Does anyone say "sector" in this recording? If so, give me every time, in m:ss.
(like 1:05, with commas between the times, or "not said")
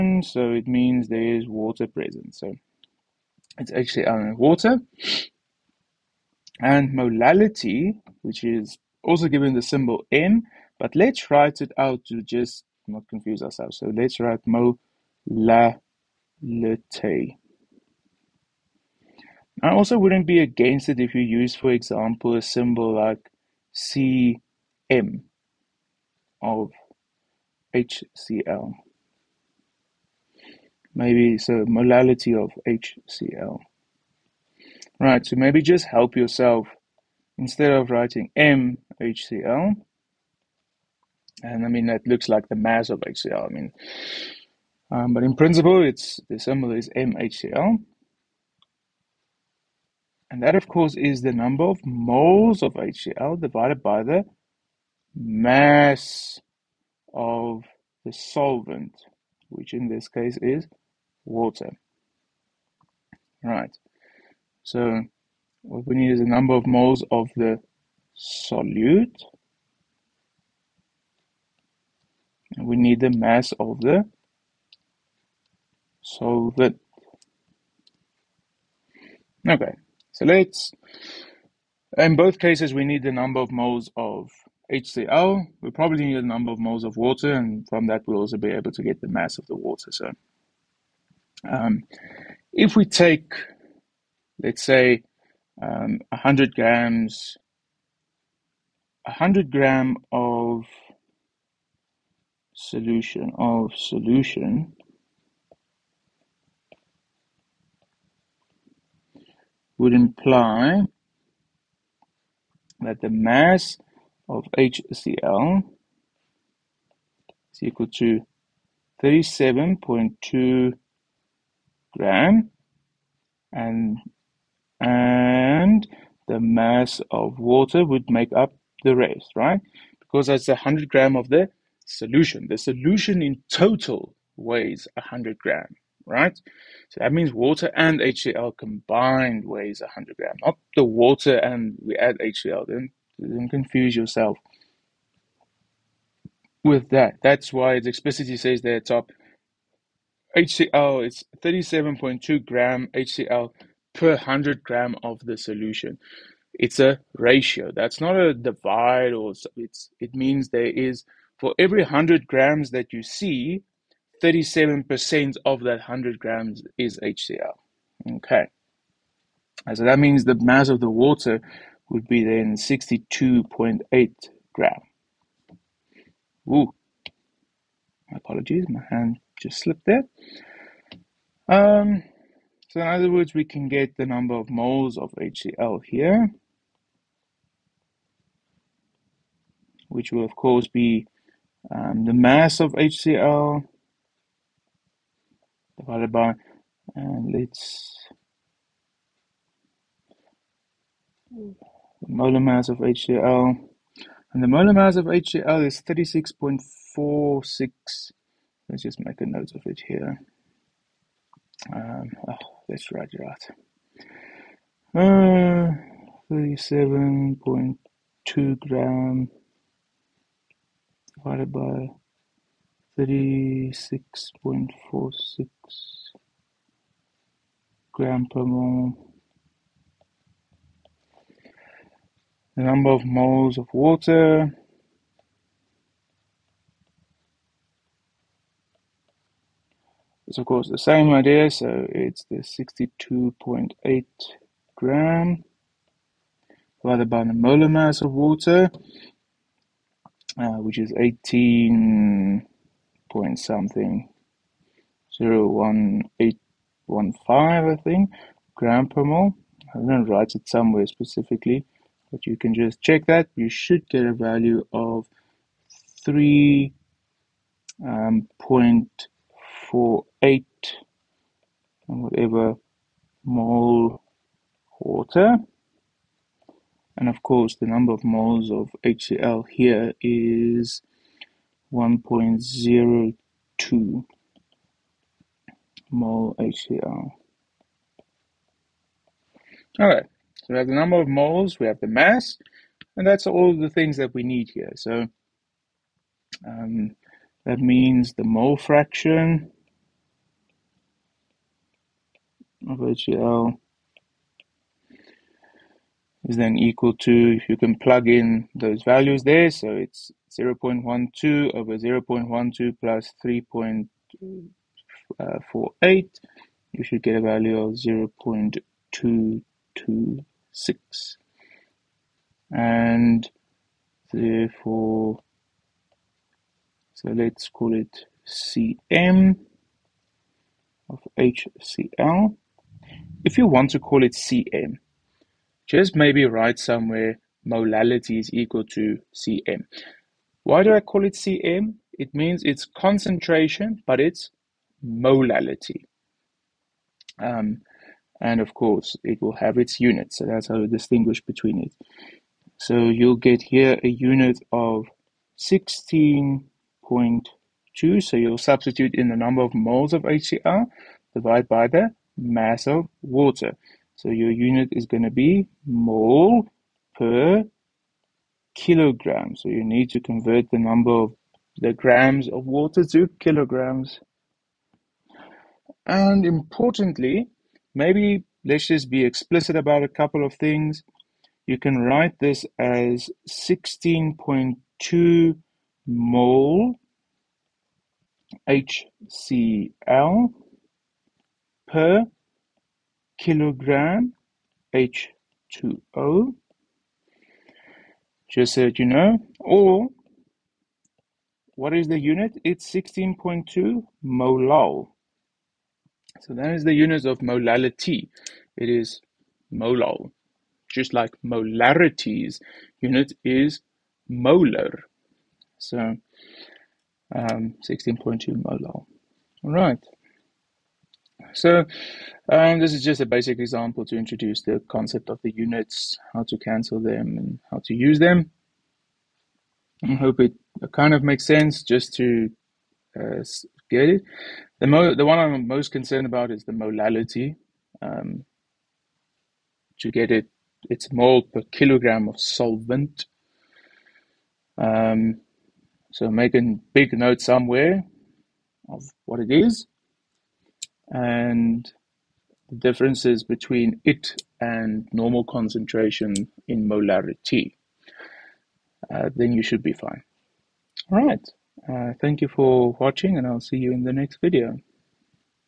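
not said.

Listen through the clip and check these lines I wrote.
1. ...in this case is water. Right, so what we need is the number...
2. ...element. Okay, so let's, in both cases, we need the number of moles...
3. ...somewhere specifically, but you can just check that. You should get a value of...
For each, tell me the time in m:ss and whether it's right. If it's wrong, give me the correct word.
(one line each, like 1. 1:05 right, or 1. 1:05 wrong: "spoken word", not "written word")
1. 0:59 right
2. 1:16 wrong: "solvent", not "element"
3. 4:20 right.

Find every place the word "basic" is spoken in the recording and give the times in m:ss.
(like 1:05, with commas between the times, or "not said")
7:03.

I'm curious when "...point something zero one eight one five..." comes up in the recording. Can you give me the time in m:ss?
4:13.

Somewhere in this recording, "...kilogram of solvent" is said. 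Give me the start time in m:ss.
7:21.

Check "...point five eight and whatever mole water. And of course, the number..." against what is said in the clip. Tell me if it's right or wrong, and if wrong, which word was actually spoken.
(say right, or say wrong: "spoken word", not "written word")
wrong: "four", not "five".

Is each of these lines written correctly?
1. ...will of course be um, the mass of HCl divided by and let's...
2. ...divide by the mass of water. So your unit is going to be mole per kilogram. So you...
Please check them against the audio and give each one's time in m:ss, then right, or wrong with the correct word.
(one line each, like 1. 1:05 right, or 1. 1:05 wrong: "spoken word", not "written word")
1. 3:10 right
2. 6:01 right.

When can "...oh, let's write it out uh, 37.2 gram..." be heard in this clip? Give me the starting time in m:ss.
3:32.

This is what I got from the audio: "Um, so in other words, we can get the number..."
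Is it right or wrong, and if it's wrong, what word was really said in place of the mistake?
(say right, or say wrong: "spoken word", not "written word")
right.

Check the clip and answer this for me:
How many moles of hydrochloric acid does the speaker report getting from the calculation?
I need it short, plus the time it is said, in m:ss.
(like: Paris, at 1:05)
1.02 moles, at 4:41.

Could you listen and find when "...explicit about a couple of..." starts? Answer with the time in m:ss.
6:19.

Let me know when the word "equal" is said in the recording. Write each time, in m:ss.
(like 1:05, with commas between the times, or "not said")
1:57, 5:06, 5:38.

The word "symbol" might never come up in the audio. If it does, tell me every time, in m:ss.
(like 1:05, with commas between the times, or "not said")
0:09, 0:22, 0:46.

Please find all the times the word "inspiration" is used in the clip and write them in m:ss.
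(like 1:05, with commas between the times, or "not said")
not said.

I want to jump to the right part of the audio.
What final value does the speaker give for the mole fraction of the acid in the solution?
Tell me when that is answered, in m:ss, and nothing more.
5:17.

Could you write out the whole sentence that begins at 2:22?
Don't, don't confuse yourself with that.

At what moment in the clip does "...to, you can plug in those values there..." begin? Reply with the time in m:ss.
5:06.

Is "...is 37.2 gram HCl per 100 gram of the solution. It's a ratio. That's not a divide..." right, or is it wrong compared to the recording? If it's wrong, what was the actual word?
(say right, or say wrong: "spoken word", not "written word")
right.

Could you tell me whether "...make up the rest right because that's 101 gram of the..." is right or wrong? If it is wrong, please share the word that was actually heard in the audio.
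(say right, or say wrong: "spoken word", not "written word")
wrong: "100", not "101".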